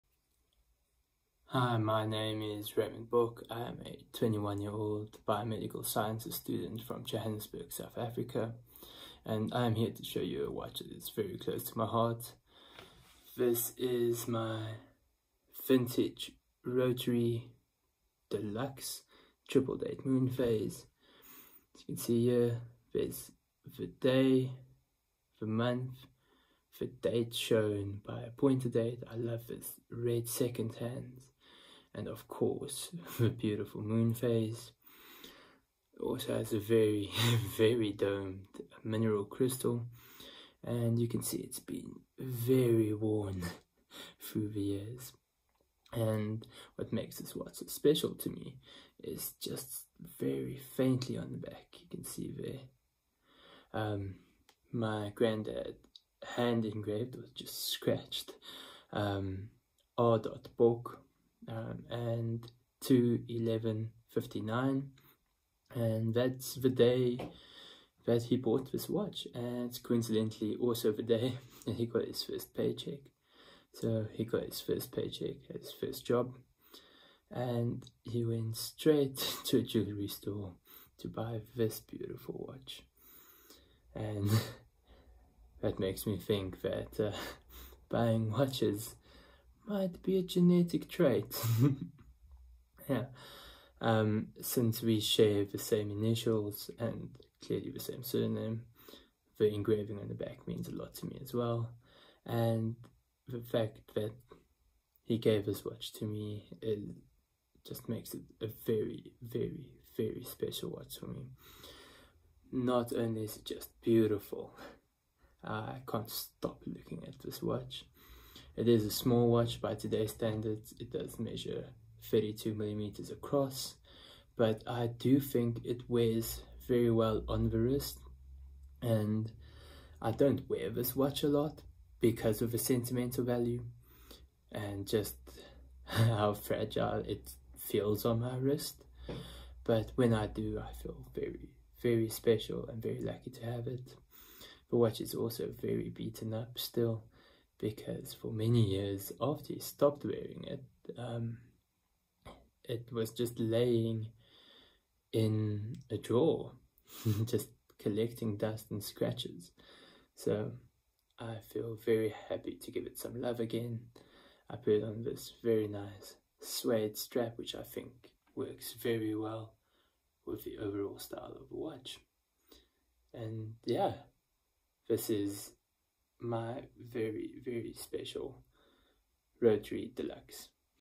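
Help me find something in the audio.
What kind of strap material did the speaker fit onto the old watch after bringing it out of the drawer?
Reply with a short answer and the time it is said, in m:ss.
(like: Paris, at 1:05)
Suede, at 2:46.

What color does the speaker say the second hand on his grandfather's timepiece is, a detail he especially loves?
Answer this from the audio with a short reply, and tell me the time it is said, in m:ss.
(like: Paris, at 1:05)
Red, at 0:29.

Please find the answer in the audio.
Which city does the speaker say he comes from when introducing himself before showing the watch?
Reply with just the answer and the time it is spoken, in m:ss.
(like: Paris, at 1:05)
Johannesburg, at 0:07.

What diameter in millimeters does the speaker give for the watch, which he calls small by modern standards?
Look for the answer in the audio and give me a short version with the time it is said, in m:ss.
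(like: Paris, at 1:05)
32 millimeters, at 2:02.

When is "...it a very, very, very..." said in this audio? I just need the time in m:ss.
1:48.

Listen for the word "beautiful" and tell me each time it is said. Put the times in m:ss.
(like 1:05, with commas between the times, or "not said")
0:33, 1:21, 1:53.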